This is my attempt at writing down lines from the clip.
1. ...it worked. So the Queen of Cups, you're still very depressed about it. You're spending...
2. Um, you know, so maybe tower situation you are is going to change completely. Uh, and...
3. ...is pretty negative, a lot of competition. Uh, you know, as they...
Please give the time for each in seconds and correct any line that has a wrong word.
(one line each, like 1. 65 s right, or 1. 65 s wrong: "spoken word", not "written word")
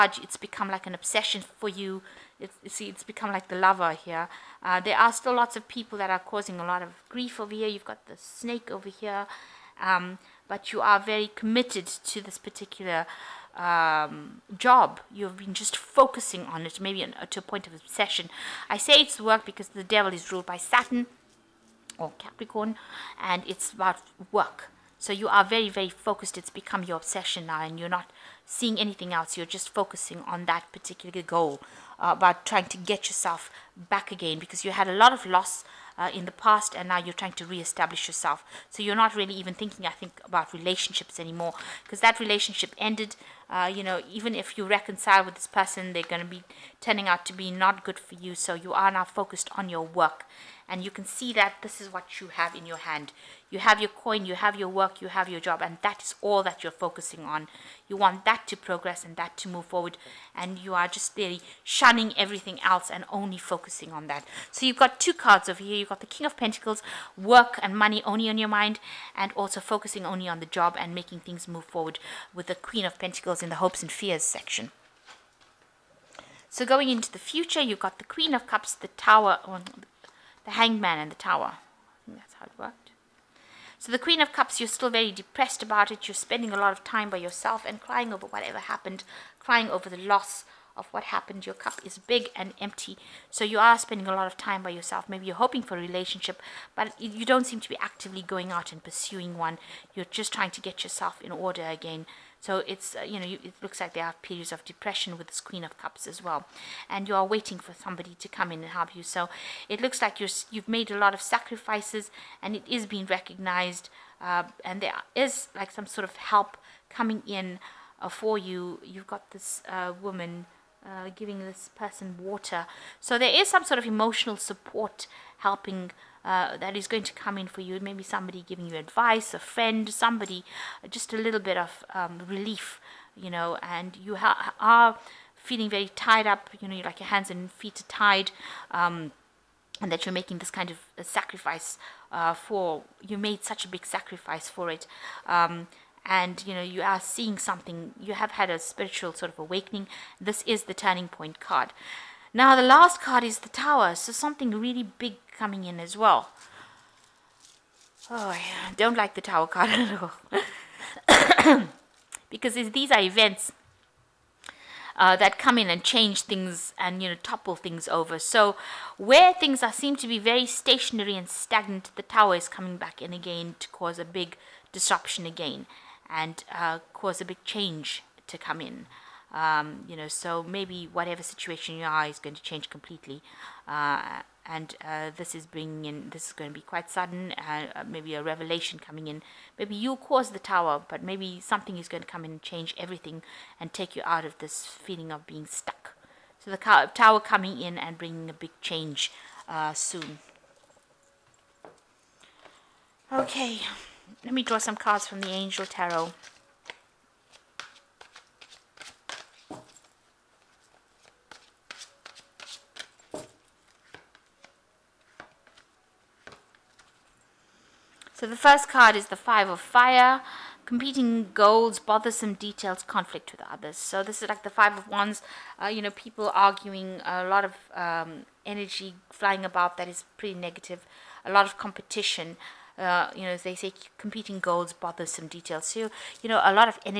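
1. 82 s right
2. 179 s wrong: "whatever", not "tower"
3. 229 s right.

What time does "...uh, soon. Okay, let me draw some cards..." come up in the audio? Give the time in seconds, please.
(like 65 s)
199 s.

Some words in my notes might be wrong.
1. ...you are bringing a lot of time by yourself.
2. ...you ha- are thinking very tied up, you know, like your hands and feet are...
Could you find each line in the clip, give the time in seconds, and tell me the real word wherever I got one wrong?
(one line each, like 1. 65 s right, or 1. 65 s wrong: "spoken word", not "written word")
1. 93 s wrong: "spending", not "bringing"
2. 133 s wrong: "feeling", not "thinking".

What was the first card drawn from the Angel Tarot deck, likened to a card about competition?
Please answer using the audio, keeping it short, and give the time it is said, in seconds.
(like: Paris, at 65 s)
Five of Fire, at 219 s.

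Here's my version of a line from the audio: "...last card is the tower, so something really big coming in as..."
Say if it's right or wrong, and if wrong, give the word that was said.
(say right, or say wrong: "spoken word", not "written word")
right.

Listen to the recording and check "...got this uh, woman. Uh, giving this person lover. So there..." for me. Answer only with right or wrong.
wrong.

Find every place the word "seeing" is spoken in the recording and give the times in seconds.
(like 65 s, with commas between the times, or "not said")
28 s, 146 s.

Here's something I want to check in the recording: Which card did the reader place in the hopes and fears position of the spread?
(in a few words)
Queen of Pentacles.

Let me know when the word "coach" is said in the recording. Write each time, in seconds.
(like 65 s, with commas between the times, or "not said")
not said.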